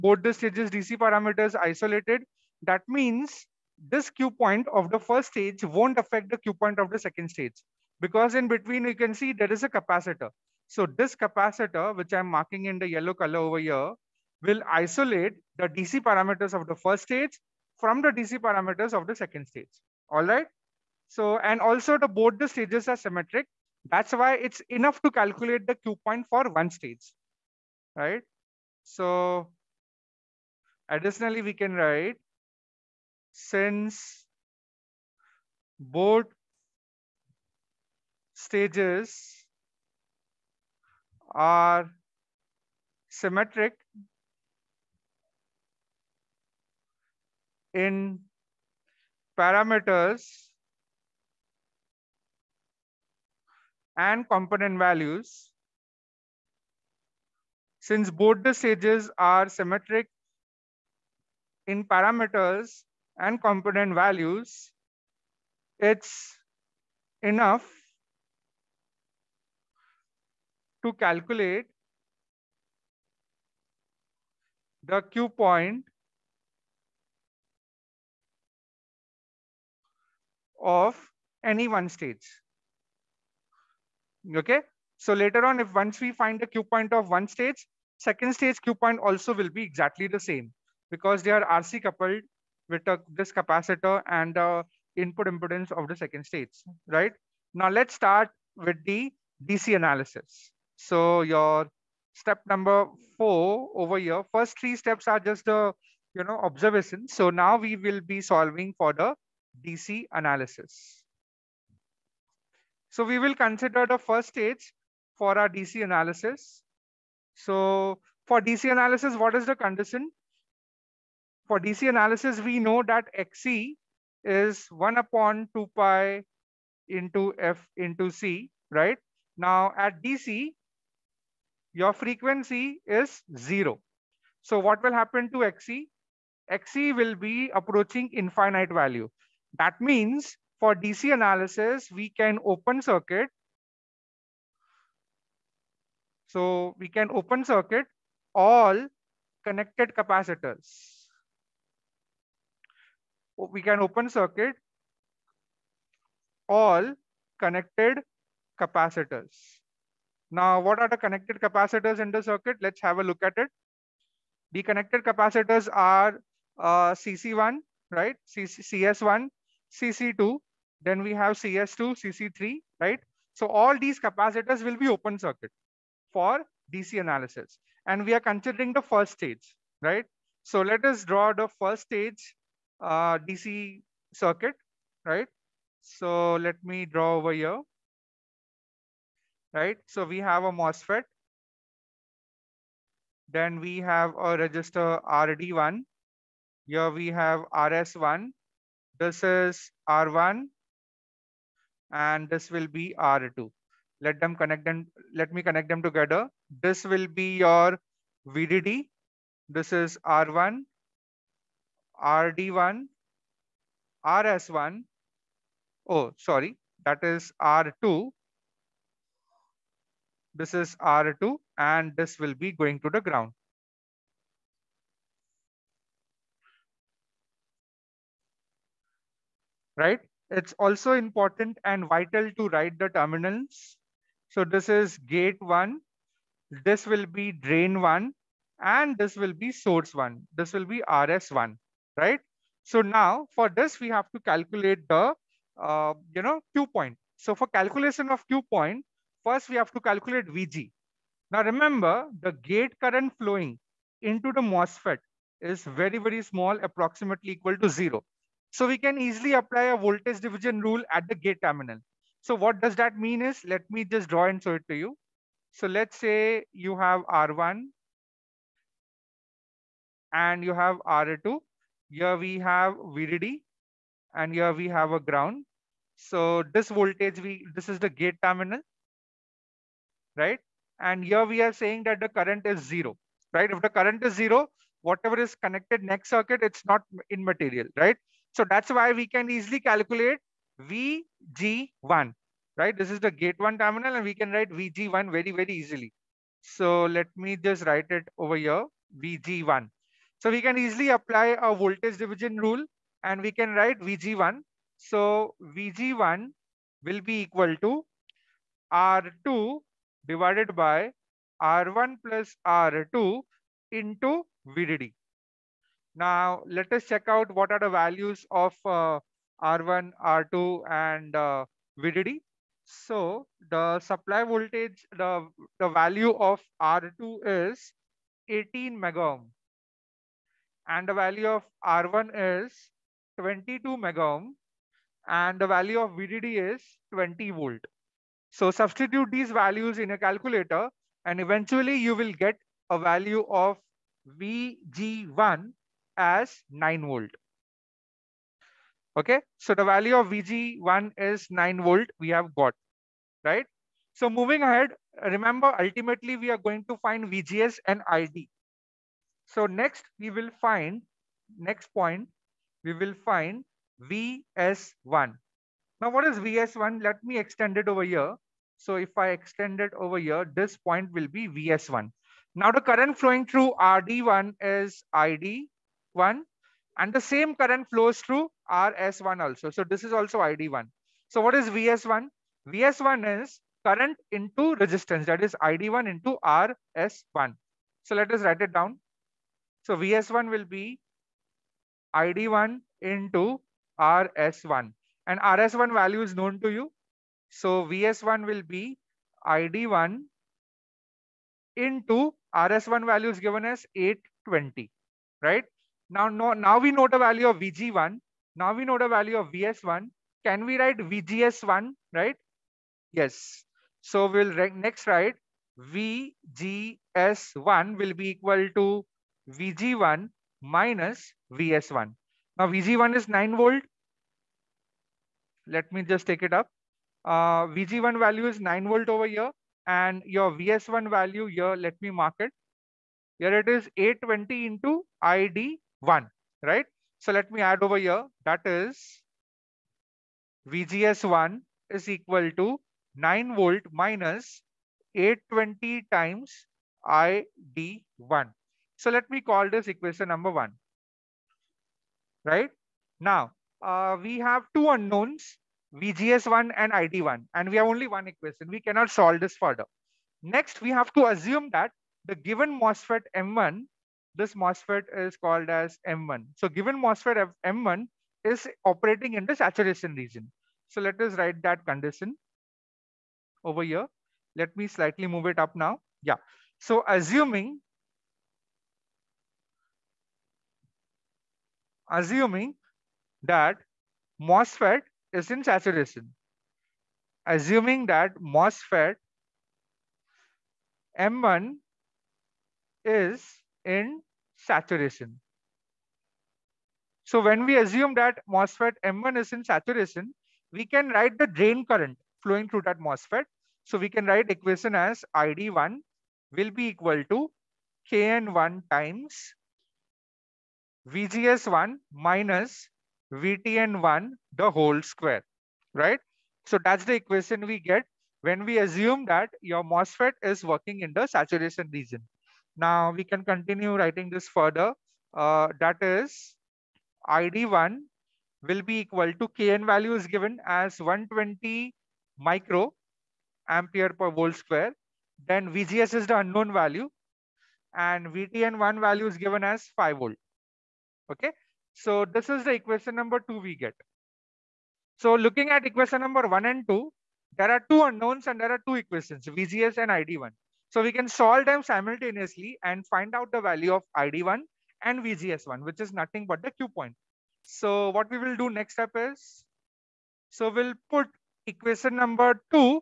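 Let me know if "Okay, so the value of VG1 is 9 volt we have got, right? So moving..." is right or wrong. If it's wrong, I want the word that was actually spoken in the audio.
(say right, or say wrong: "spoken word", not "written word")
right.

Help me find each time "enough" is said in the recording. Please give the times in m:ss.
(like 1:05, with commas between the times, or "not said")
0:24, 1:07.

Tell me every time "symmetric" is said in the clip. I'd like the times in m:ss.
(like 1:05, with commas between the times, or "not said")
0:22, 0:43, 0:59.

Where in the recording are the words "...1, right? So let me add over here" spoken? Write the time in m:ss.
7:15.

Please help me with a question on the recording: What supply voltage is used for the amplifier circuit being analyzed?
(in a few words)
20 volt.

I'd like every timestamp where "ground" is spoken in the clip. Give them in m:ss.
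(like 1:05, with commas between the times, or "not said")
3:43, 4:35.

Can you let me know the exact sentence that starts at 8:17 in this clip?
So when we assume that MOSFET M1 is in saturation, we can write the drain current flowing through that MOSFET.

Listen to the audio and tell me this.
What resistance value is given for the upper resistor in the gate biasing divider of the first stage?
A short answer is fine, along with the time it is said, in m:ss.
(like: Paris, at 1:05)
22 megohm, at 5:33.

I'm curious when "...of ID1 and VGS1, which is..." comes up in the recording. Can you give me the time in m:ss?
9:13.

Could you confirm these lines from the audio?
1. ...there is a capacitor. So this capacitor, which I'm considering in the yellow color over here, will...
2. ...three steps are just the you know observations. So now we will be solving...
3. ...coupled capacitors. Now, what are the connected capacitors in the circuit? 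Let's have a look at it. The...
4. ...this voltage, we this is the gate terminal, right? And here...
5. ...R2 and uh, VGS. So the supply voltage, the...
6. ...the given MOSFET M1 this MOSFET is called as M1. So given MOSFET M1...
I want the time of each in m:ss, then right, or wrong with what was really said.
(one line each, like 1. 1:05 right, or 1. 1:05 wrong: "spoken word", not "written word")
1. 0:09 wrong: "marking", not "considering"
2. 1:44 right
3. 2:37 wrong: "connected", not "coupled"
4. 4:36 right
5. 5:20 wrong: "VDD", not "VGS"
6. 7:42 right.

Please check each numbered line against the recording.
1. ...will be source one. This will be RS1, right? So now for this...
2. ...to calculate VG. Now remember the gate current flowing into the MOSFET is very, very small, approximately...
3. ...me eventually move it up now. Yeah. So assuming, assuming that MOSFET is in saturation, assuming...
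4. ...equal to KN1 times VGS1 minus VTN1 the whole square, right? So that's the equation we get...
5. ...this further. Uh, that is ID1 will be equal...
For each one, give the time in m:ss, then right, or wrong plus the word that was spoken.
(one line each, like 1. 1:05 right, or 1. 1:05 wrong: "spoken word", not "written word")
1. 3:59 right
2. 4:09 right
3. 7:54 wrong: "slightly", not "eventually"
4. 8:26 right
5. 8:44 right.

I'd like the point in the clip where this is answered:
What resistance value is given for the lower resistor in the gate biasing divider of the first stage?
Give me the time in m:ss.
5:28.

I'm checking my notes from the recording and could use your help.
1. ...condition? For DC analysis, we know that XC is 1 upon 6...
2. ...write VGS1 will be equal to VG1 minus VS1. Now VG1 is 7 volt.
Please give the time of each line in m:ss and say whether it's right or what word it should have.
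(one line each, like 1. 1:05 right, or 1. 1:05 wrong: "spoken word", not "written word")
1. 1:59 wrong: "2", not "6"
2. 6:54 wrong: "9", not "7".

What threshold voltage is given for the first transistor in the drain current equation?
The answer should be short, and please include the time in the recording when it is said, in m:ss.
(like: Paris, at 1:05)
5 volt, at 8:59.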